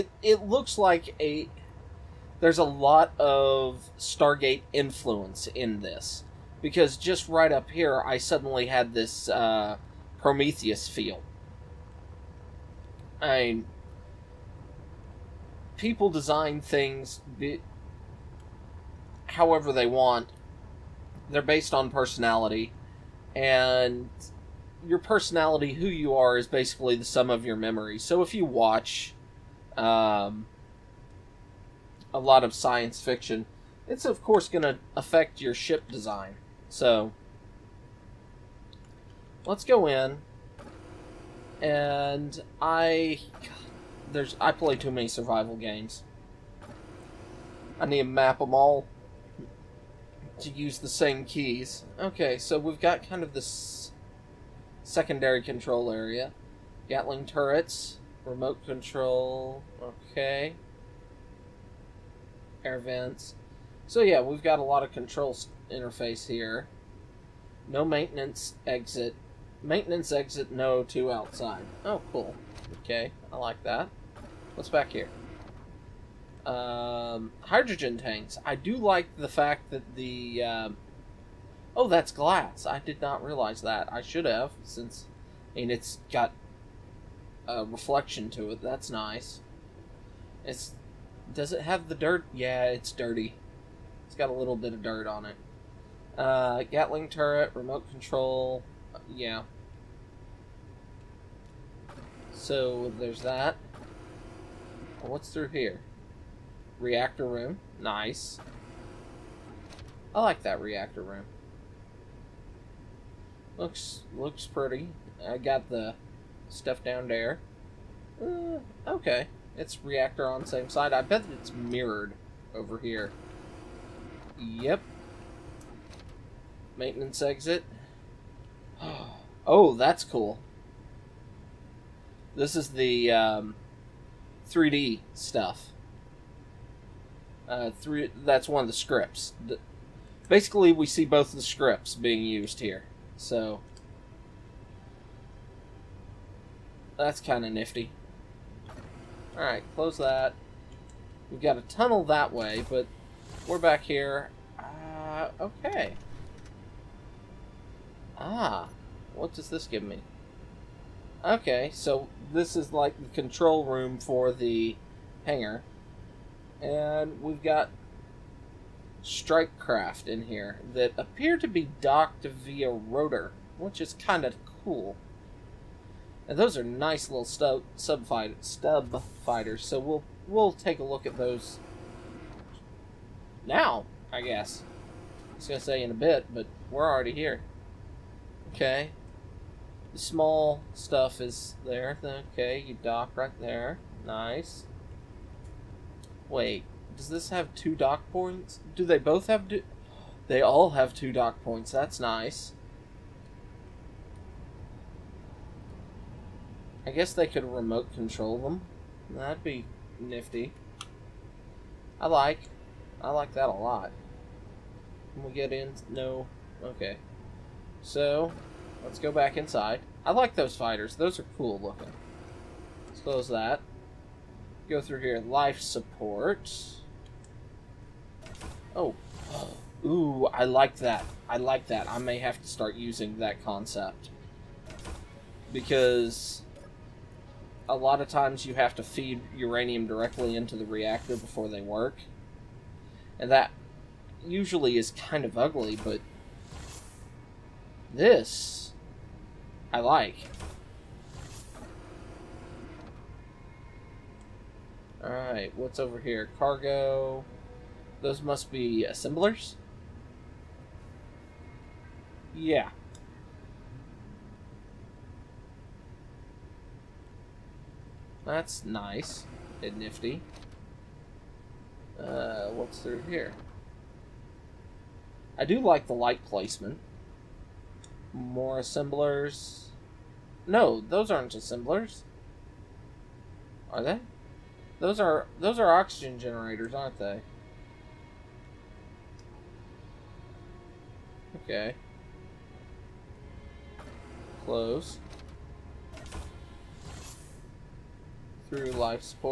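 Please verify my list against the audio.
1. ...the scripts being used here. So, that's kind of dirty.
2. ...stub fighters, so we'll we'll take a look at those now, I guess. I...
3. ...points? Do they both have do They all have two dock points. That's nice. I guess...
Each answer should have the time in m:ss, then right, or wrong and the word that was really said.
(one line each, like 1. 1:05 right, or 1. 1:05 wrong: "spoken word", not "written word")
1. 2:21 wrong: "nifty", not "dirty"
2. 2:58 right
3. 3:18 right.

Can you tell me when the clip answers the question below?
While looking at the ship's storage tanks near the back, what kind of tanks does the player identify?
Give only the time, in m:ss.
1:17.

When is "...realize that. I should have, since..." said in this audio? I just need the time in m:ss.
1:23.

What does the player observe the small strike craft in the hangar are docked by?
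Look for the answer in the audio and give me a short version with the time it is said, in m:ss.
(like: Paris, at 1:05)
Rotor, at 2:52.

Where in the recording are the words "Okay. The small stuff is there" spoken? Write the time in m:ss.
3:08.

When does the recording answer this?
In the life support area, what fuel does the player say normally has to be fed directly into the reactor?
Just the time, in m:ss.
3:59.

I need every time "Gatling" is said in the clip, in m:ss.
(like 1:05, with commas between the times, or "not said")
0:56, 1:36.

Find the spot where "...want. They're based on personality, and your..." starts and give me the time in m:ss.
0:19.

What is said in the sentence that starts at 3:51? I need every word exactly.
I may have to start using that concept.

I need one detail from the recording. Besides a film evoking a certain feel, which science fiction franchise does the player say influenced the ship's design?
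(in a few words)
Stargate.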